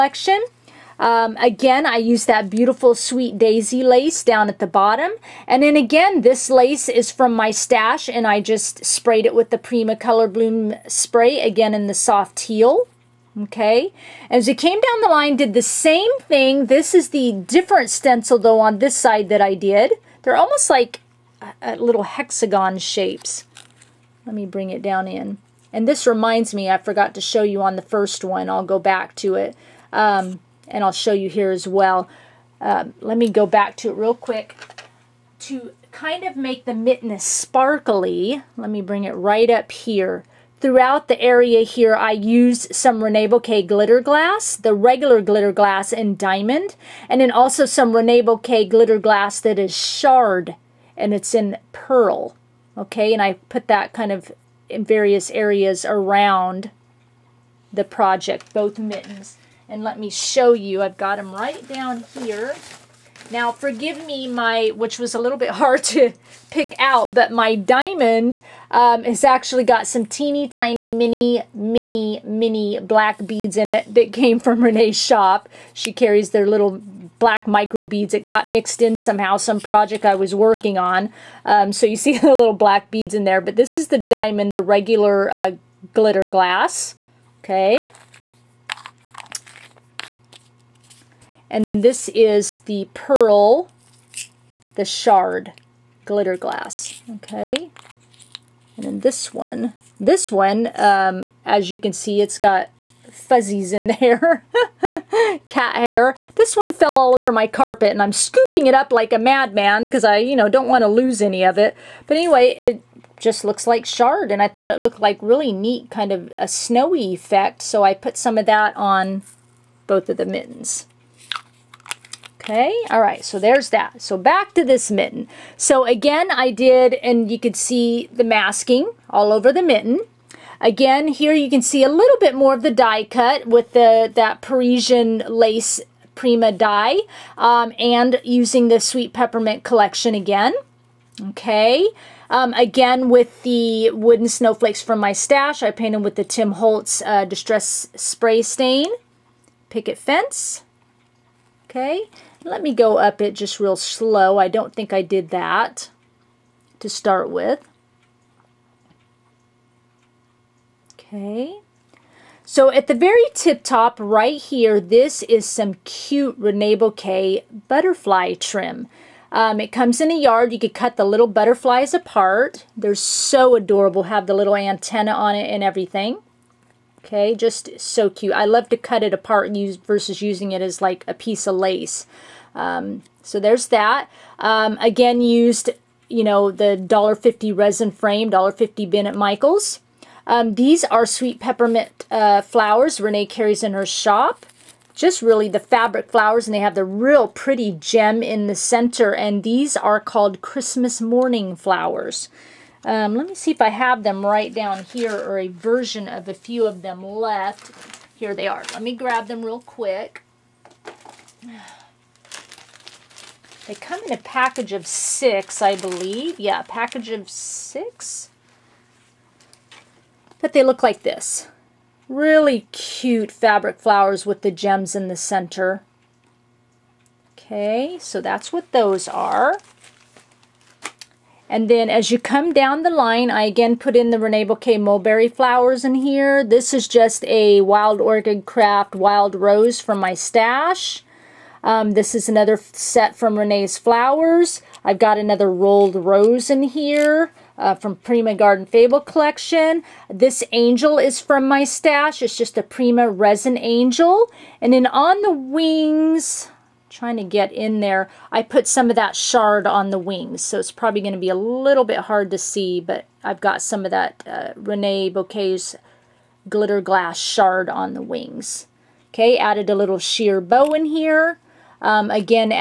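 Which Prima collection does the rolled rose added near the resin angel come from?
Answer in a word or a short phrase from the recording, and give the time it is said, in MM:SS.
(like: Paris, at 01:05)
Garden Fable, at 04:08.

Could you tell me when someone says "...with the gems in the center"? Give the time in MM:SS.
03:44.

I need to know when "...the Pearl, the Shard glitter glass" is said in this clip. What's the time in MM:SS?
01:32.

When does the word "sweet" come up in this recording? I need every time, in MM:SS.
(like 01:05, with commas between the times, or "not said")
00:02, 02:18, 03:11.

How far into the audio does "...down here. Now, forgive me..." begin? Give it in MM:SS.
01:01.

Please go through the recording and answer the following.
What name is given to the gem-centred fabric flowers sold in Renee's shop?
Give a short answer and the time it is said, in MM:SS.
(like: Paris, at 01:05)
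Christmas morning flowers, at 03:20.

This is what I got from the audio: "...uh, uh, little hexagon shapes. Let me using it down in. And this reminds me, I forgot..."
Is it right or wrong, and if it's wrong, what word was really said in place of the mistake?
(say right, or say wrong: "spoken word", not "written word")
wrong: "bring", not "using".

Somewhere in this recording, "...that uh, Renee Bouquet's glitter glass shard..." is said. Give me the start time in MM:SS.
04:23.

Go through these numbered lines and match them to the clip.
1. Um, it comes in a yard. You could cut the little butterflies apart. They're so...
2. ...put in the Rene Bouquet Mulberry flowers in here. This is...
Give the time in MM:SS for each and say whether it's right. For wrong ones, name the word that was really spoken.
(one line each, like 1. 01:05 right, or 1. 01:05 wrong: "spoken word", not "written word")
1. 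02:49 right
2. 03:53 right.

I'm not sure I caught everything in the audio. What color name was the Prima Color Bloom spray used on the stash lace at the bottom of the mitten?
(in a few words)
soft teal.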